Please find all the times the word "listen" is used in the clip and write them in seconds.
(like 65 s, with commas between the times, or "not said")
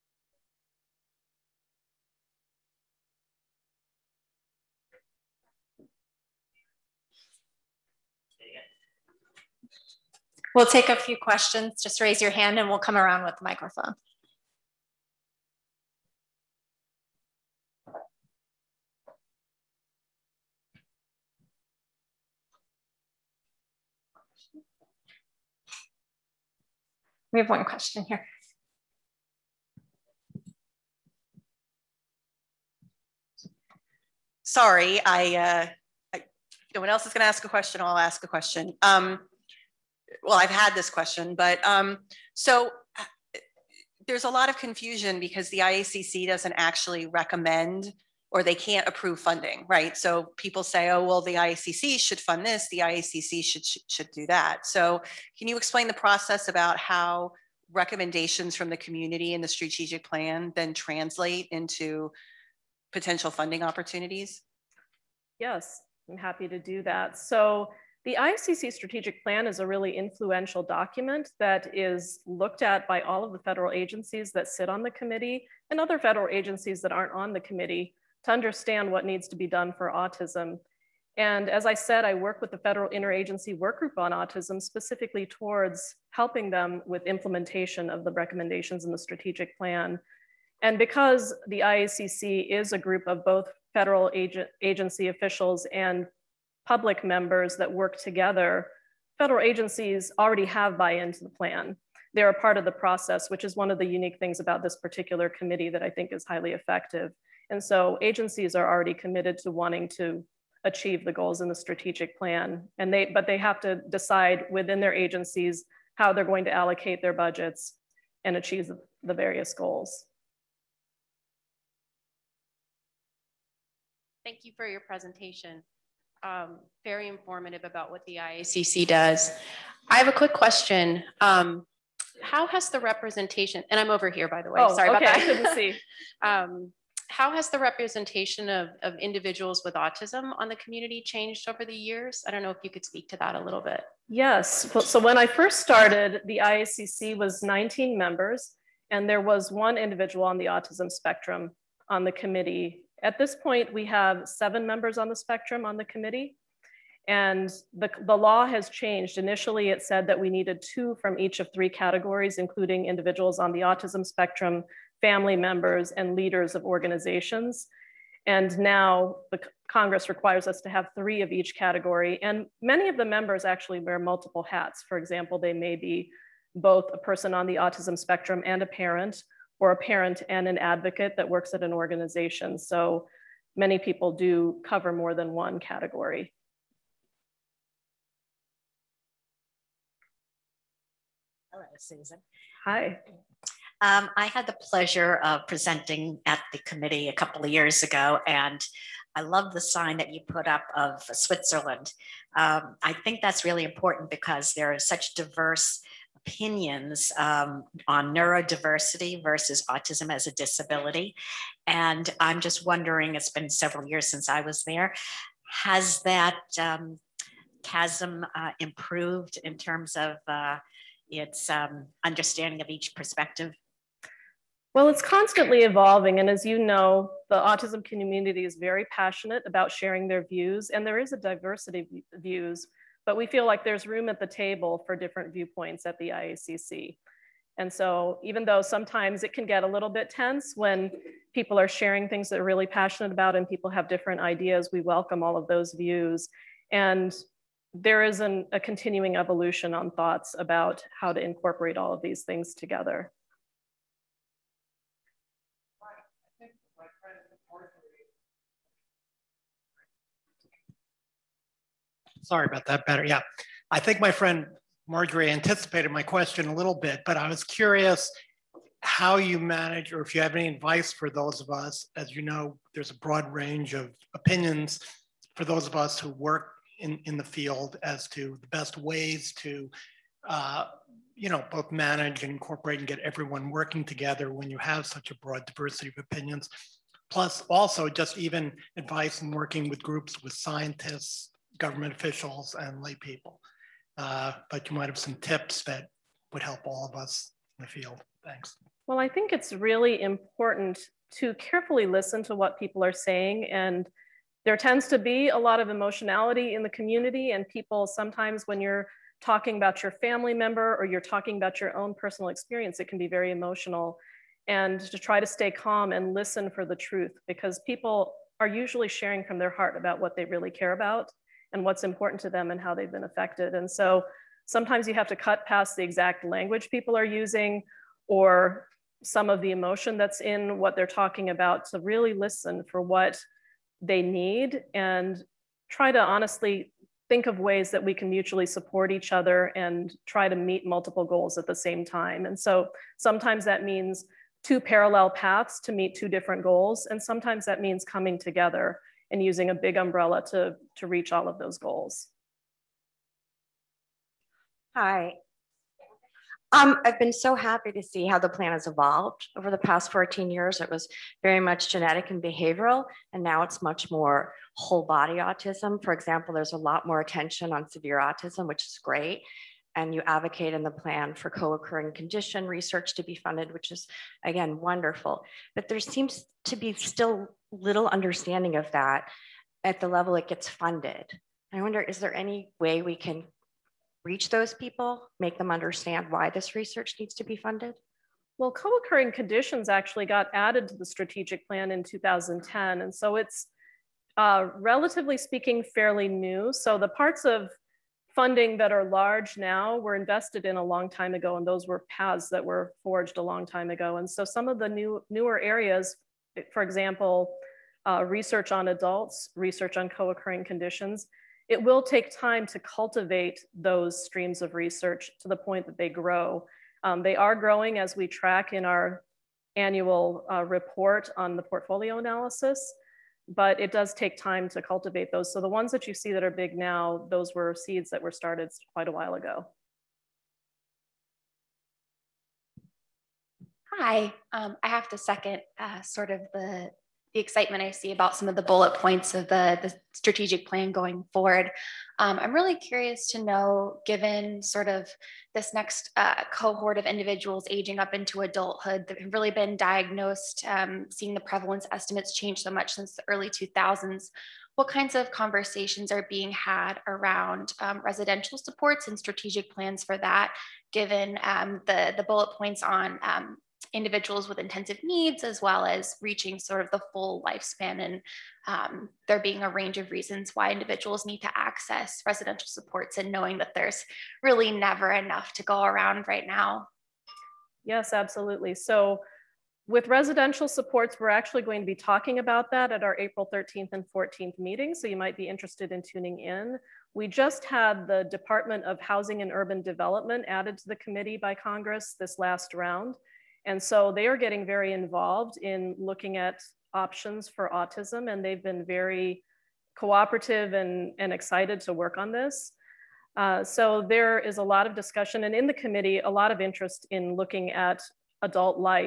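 301 s, 316 s, 332 s.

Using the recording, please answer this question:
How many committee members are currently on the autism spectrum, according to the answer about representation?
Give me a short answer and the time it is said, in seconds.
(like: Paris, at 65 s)
7, at 154 s.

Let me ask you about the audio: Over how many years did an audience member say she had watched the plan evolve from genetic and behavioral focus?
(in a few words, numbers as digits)
14.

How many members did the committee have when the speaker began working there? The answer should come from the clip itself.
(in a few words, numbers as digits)
19.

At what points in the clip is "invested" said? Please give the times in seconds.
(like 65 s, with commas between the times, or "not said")
399 s.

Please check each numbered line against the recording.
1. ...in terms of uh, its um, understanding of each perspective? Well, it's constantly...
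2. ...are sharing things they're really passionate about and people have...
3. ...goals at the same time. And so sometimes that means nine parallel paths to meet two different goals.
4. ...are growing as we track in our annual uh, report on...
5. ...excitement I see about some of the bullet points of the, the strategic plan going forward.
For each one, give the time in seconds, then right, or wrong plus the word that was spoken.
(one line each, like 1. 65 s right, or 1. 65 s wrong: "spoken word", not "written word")
1. 219 s right
2. 241 s right
3. 341 s wrong: "two", not "nine"
4. 417 s right
5. 437 s right.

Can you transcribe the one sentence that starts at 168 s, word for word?
And now the Congress requires us to have three of each category.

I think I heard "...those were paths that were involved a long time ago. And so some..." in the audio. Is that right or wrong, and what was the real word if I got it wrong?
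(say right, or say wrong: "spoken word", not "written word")
wrong: "forged", not "involved".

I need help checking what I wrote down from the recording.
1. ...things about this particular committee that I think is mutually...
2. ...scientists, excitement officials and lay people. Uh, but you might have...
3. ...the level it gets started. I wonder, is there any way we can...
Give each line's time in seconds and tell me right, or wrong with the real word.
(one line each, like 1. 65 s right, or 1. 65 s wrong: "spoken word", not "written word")
1. 104 s wrong: "highly", not "mutually"
2. 290 s wrong: "government", not "excitement"
3. 379 s wrong: "funded", not "started".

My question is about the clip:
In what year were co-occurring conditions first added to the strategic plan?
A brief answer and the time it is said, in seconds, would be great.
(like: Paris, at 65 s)
2010, at 391 s.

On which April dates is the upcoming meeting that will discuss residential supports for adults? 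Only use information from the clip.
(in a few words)
April 13th and 14th.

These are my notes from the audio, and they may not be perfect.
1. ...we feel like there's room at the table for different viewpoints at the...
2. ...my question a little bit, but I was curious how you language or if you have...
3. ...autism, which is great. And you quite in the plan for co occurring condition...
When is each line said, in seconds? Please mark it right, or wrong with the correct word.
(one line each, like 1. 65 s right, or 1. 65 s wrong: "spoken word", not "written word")
1. 233 s right
2. 265 s wrong: "manage", not "language"
3. 367 s wrong: "advocate", not "quite".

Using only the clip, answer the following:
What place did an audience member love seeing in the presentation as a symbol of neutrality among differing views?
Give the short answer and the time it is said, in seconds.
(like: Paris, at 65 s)
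Switzerland, at 201 s.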